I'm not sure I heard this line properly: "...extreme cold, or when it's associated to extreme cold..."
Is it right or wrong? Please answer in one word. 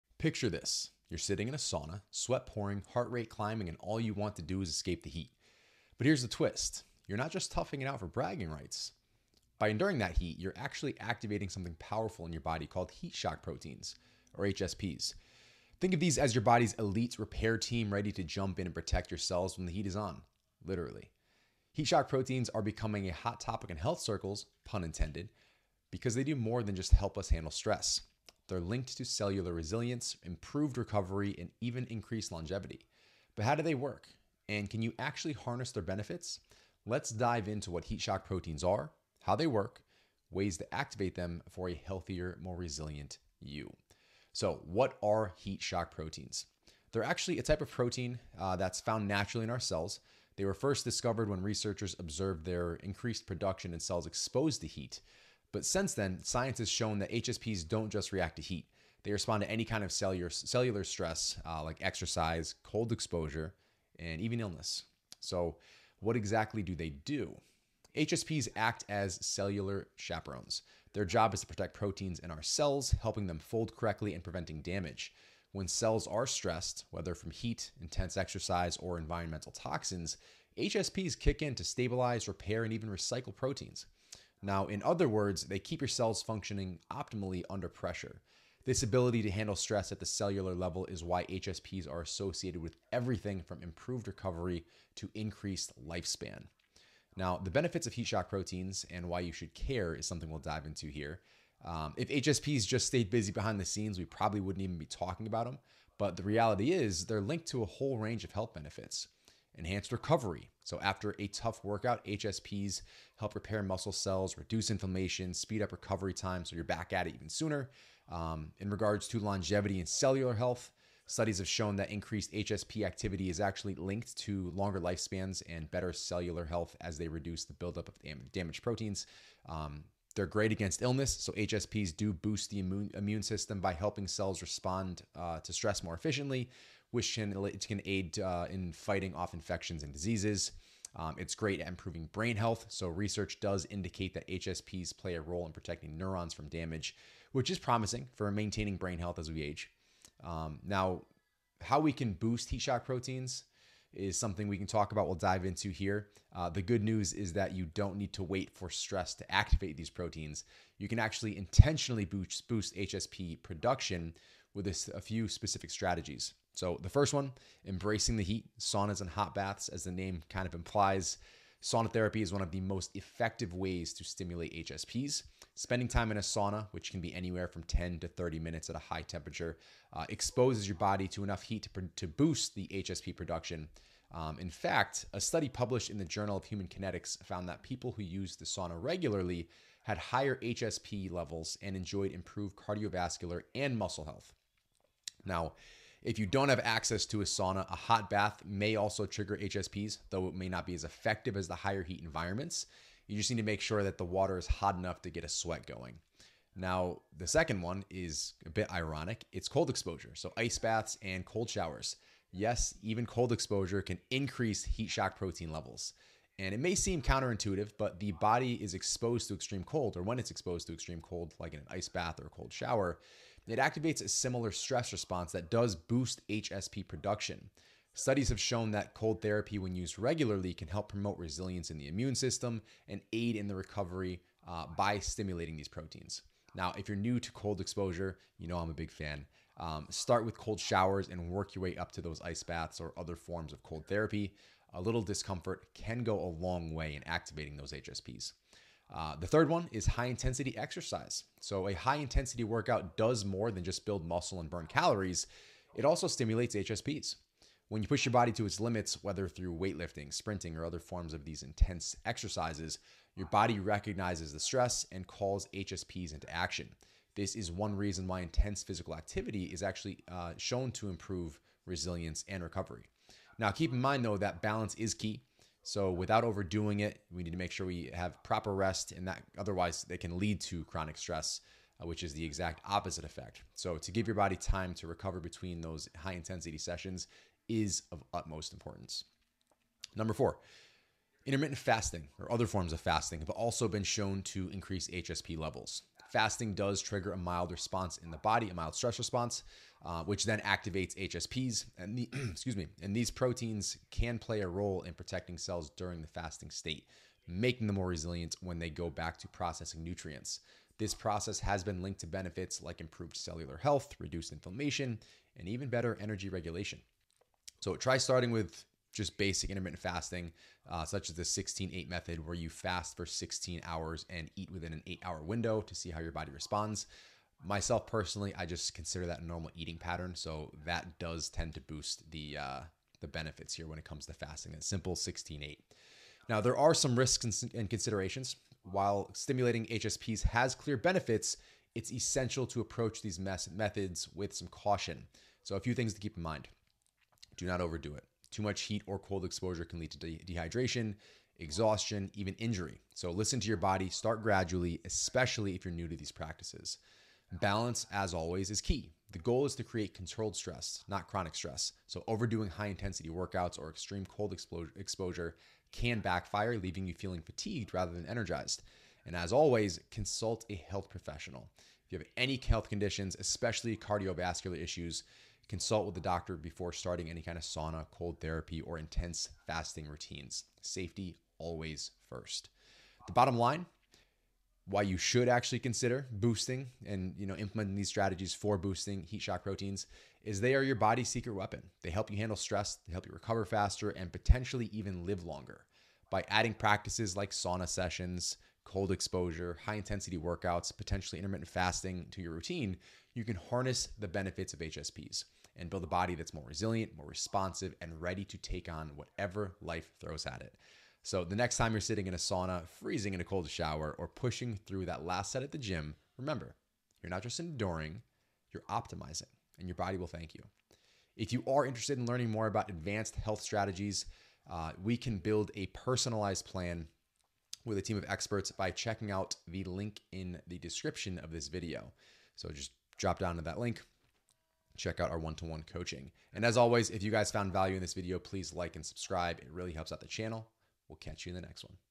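wrong.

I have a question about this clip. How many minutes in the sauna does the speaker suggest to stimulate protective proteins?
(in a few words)
10 to 30 minutes.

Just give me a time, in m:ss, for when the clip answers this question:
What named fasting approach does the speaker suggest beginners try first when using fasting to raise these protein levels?
5:21.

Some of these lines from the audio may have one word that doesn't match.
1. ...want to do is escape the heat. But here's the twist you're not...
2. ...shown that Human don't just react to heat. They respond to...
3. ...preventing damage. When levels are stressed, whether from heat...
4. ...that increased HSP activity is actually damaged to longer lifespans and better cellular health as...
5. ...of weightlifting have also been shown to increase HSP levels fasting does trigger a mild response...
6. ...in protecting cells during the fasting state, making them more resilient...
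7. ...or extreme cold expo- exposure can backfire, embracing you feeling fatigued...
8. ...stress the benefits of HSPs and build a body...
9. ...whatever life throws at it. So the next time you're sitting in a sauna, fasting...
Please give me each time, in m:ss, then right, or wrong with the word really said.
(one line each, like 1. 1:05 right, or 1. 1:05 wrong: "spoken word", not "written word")
1. 0:04 right
2. 0:56 wrong: "HSPs", not "Human"
3. 1:14 wrong: "cells", not "levels"
4. 2:01 wrong: "linked", not "damaged"
5. 4:52 wrong: "fasting", not "weightlifting"
6. 5:04 right
7. 6:03 wrong: "leaving", not "embracing"
8. 6:43 wrong: "harness", not "stress"
9. 6:48 wrong: "freezing", not "fasting".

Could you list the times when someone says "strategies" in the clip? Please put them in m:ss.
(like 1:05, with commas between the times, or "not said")
2:45, 6:27, 7:03.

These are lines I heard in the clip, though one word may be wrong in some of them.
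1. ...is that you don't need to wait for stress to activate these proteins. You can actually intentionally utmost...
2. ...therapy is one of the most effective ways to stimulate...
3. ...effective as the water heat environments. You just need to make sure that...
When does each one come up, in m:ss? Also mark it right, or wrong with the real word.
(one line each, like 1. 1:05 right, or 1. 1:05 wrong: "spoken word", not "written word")
1. 2:37 wrong: "boost", not "utmost"
2. 2:51 right
3. 3:20 wrong: "higher", not "water".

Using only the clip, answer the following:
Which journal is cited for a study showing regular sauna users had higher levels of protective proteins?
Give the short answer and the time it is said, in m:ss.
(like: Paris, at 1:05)
Journal of Human Kinetics, at 3:06.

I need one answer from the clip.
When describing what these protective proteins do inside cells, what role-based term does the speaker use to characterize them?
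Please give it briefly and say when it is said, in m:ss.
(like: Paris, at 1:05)
cellular chaperones, at 1:09.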